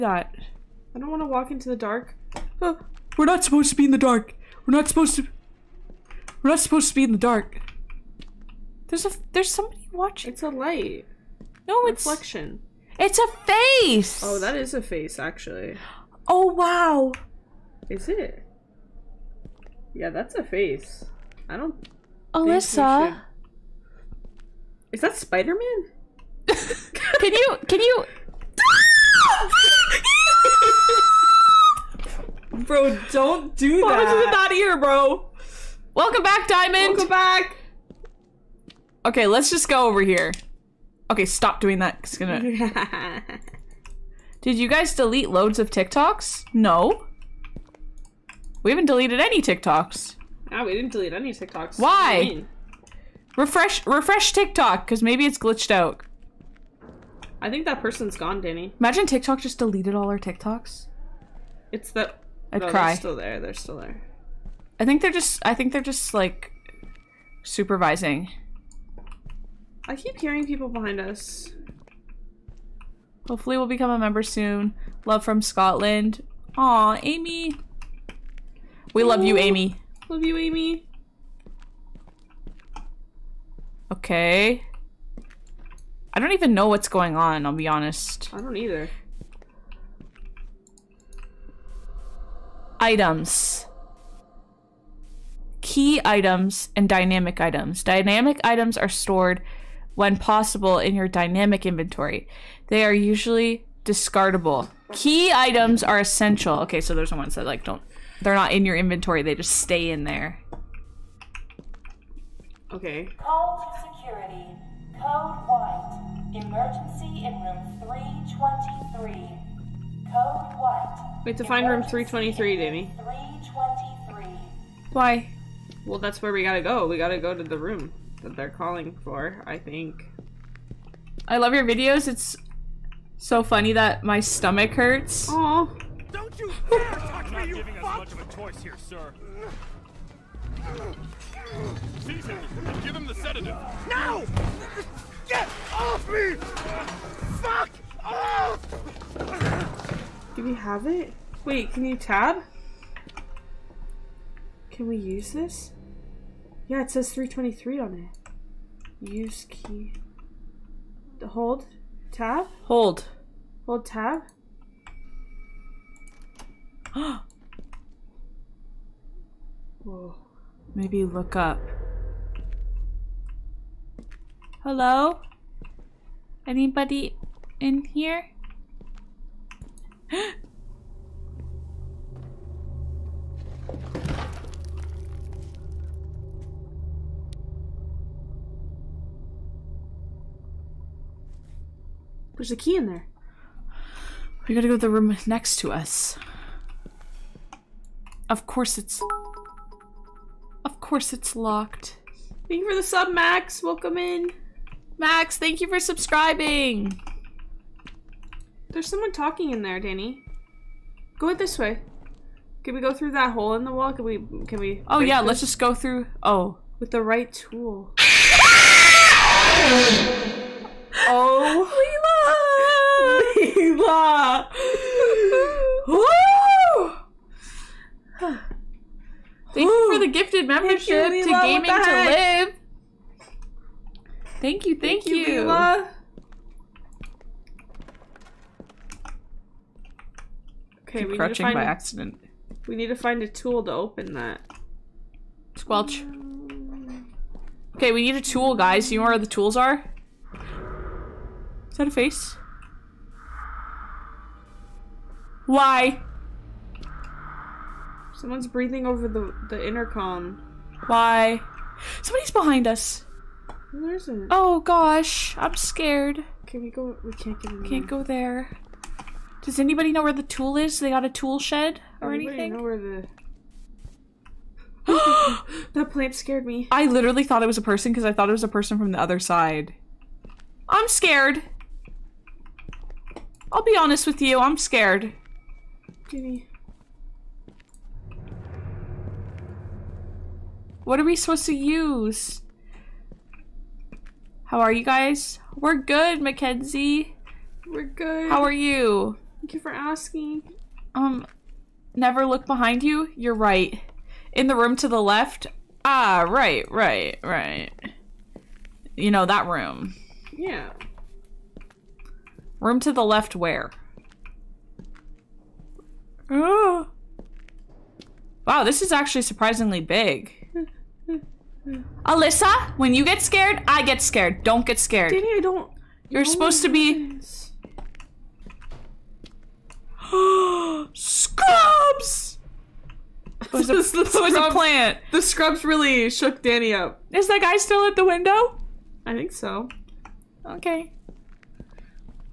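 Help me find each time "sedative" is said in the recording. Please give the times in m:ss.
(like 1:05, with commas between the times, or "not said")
2:23.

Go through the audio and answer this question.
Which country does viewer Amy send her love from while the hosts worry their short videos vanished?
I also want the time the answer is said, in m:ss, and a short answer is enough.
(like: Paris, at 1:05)
Scotland, at 1:15.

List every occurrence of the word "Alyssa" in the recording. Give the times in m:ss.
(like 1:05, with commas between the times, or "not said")
0:22, 5:22.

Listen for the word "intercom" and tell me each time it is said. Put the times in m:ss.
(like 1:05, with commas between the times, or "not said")
4:19.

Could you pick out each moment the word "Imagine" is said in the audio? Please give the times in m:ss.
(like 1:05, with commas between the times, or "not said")
0:58.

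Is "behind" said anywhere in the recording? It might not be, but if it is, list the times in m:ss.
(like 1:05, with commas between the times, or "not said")
1:10, 4:22, 5:02.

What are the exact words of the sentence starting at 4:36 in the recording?
I literally thought it was a person because I thought it was a person from the other side.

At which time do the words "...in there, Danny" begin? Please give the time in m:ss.
3:29.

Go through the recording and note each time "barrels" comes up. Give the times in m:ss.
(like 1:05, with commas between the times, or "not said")
not said.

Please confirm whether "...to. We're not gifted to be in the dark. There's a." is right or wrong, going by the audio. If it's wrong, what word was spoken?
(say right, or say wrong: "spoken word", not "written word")
wrong: "supposed", not "gifted".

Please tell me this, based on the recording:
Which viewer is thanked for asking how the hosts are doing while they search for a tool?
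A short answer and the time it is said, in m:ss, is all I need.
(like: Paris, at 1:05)
Mackenzie, at 4:56.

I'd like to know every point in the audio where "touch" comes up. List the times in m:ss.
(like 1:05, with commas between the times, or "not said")
2:16.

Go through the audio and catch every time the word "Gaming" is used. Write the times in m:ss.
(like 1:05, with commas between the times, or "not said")
3:51.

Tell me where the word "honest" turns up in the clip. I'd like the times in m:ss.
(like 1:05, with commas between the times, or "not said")
1:27, 4:43.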